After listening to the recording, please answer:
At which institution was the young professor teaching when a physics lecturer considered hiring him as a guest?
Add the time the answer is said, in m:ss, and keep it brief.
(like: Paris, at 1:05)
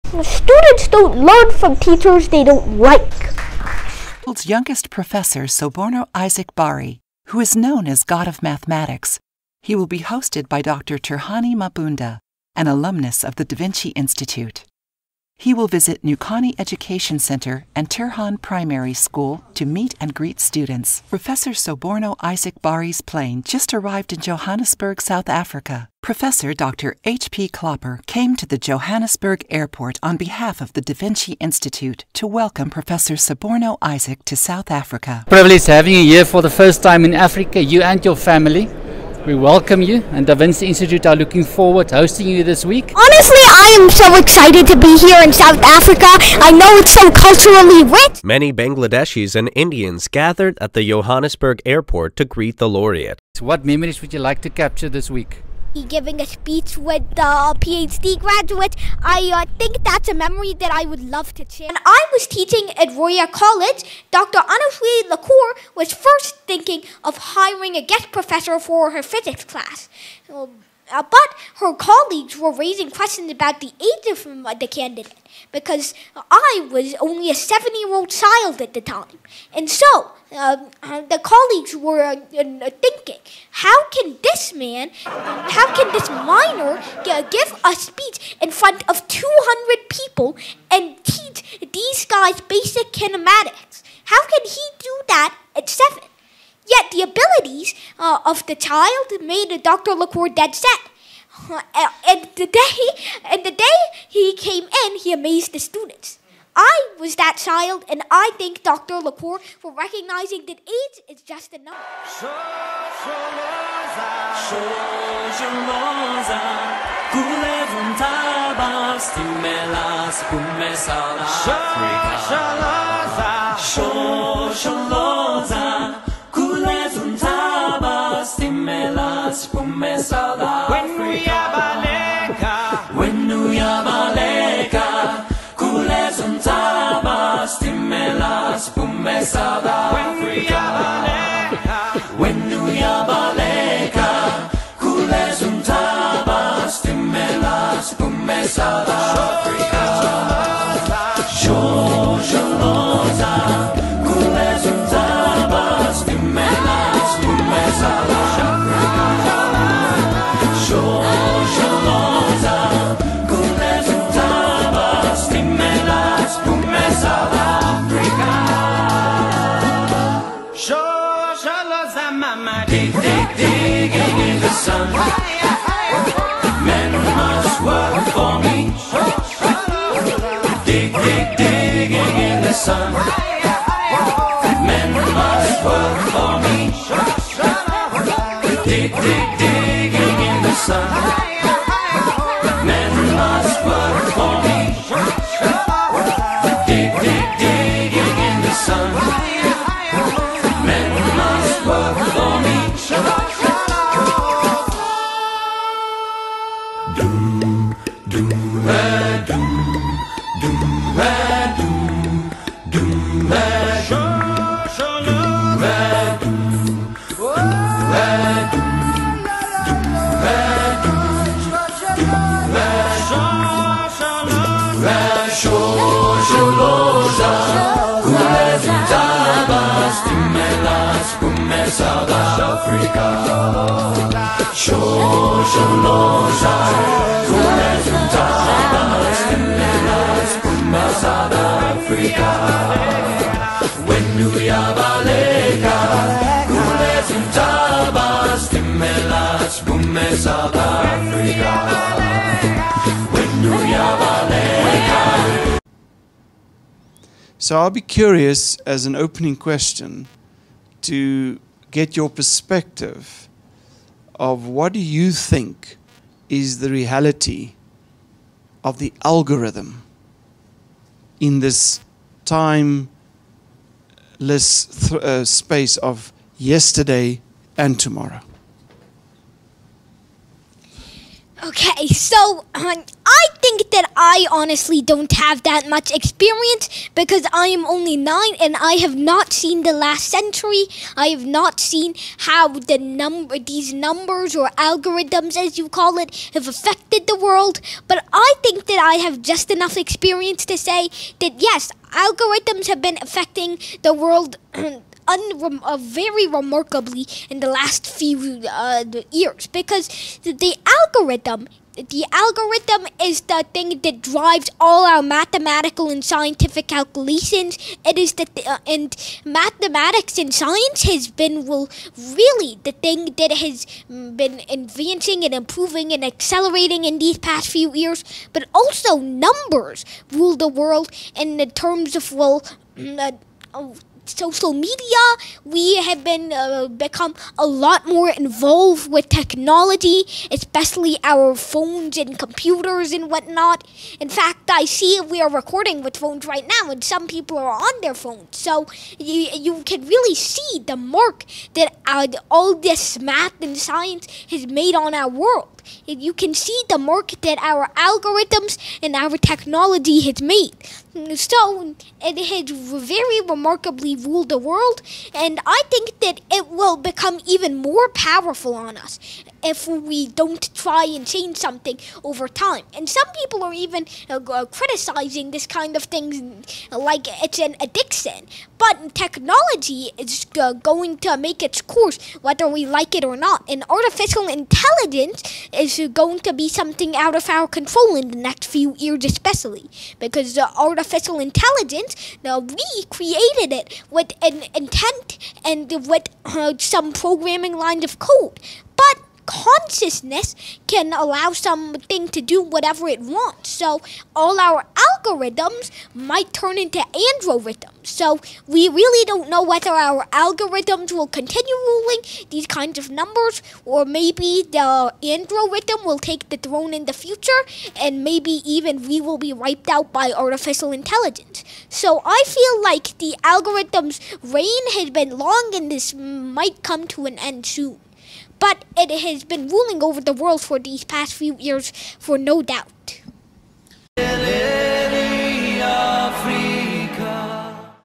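Royal College, at 1:02.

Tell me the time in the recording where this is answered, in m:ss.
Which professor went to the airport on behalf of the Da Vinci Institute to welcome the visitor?
0:26.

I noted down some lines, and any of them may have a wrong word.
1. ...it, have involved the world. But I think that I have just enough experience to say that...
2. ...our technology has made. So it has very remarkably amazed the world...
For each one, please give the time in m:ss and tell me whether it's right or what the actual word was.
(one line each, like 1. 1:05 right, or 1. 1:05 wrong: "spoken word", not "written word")
1. 4:55 wrong: "affected", not "involved"
2. 5:58 wrong: "ruled", not "amazed".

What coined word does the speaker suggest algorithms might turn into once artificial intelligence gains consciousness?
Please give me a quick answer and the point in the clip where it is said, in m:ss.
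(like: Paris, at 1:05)
Androrithms, at 6:46.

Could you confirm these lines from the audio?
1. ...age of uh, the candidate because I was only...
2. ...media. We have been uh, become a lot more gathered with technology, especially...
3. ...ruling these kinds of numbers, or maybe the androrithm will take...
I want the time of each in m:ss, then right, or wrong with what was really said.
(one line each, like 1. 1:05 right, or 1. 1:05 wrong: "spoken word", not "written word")
1. 1:13 right
2. 5:34 wrong: "involved", not "gathered"
3. 6:51 right.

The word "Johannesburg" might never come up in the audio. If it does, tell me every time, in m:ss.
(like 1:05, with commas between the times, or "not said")
0:24, 0:28, 0:50.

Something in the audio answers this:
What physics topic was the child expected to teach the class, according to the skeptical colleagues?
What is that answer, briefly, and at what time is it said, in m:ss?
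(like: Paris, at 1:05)
Basic kinematics, at 1:32.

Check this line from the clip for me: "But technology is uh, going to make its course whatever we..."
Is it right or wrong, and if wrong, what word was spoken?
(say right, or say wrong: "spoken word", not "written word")
wrong: "whether", not "whatever".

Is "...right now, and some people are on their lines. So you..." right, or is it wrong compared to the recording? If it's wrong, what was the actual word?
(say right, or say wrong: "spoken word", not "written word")
wrong: "phones", not "lines".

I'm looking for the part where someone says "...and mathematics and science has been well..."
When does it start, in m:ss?
5:18.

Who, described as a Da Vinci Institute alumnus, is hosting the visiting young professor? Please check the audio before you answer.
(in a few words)
Dr. Turhani Mabunda.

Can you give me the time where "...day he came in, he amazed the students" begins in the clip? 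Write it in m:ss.
1:43.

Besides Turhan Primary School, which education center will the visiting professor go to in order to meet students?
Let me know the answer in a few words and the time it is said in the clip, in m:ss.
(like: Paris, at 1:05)
Nukani Education Center, at 0:16.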